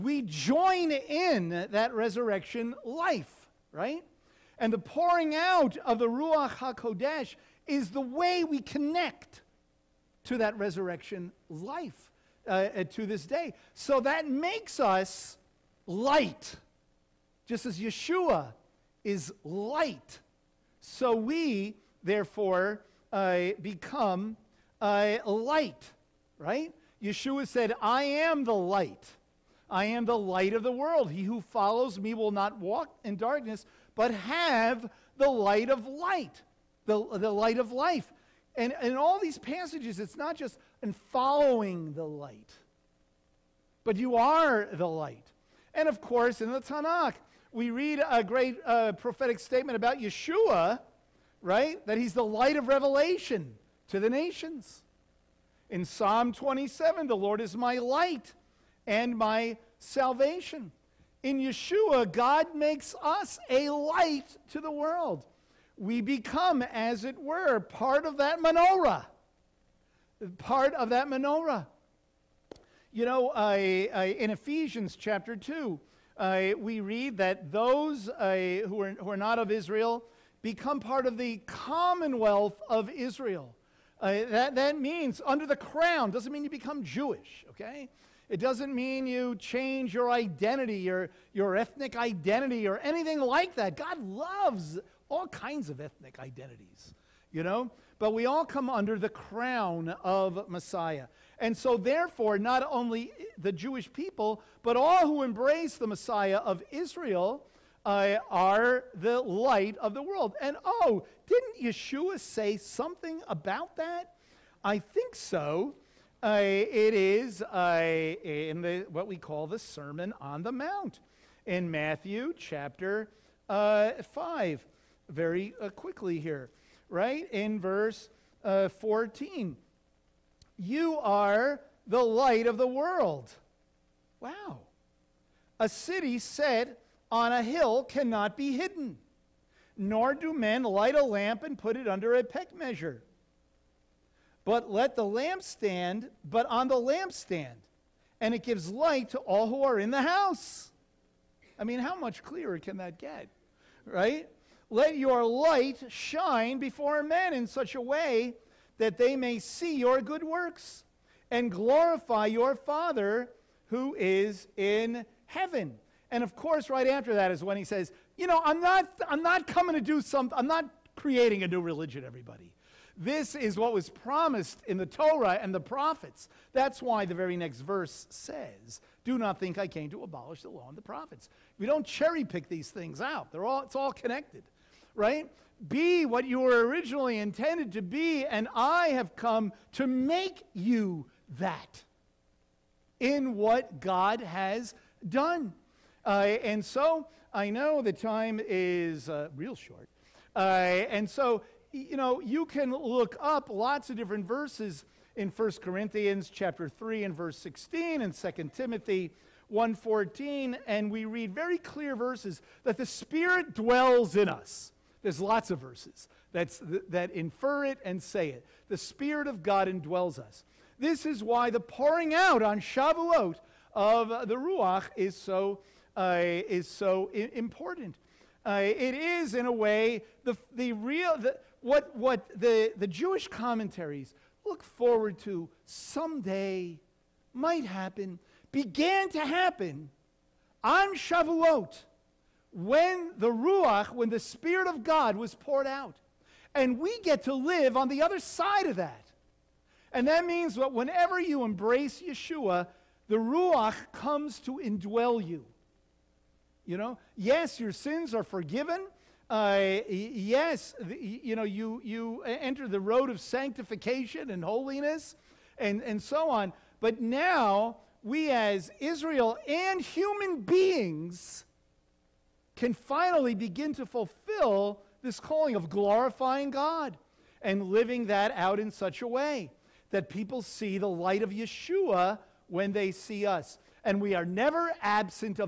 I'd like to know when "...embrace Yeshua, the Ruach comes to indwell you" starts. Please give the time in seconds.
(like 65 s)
251 s.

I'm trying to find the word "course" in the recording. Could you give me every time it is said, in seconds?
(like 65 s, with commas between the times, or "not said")
45 s, 166 s.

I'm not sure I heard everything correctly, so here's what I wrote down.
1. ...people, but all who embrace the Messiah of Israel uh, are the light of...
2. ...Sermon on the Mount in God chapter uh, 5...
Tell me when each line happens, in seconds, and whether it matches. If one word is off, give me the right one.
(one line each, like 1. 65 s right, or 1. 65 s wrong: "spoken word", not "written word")
1. 103 s right
2. 119 s wrong: "Matthew", not "God".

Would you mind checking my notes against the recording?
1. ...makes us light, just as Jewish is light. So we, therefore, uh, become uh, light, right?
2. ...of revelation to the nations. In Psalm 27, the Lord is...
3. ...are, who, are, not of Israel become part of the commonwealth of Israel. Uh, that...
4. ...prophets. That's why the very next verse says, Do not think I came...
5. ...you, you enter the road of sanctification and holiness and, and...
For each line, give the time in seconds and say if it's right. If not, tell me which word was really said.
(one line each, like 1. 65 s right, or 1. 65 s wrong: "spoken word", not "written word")
1. 14 s wrong: "Yeshua", not "Jewish"
2. 52 s right
3. 78 s right
4. 175 s right
5. 261 s right.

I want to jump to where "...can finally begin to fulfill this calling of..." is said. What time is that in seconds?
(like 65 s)
272 s.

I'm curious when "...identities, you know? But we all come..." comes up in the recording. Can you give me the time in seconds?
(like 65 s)
96 s.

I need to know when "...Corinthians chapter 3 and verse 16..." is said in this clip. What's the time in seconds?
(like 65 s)
205 s.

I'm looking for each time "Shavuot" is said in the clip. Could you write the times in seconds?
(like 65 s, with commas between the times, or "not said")
222 s, 240 s.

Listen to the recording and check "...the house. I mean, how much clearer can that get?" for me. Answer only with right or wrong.
right.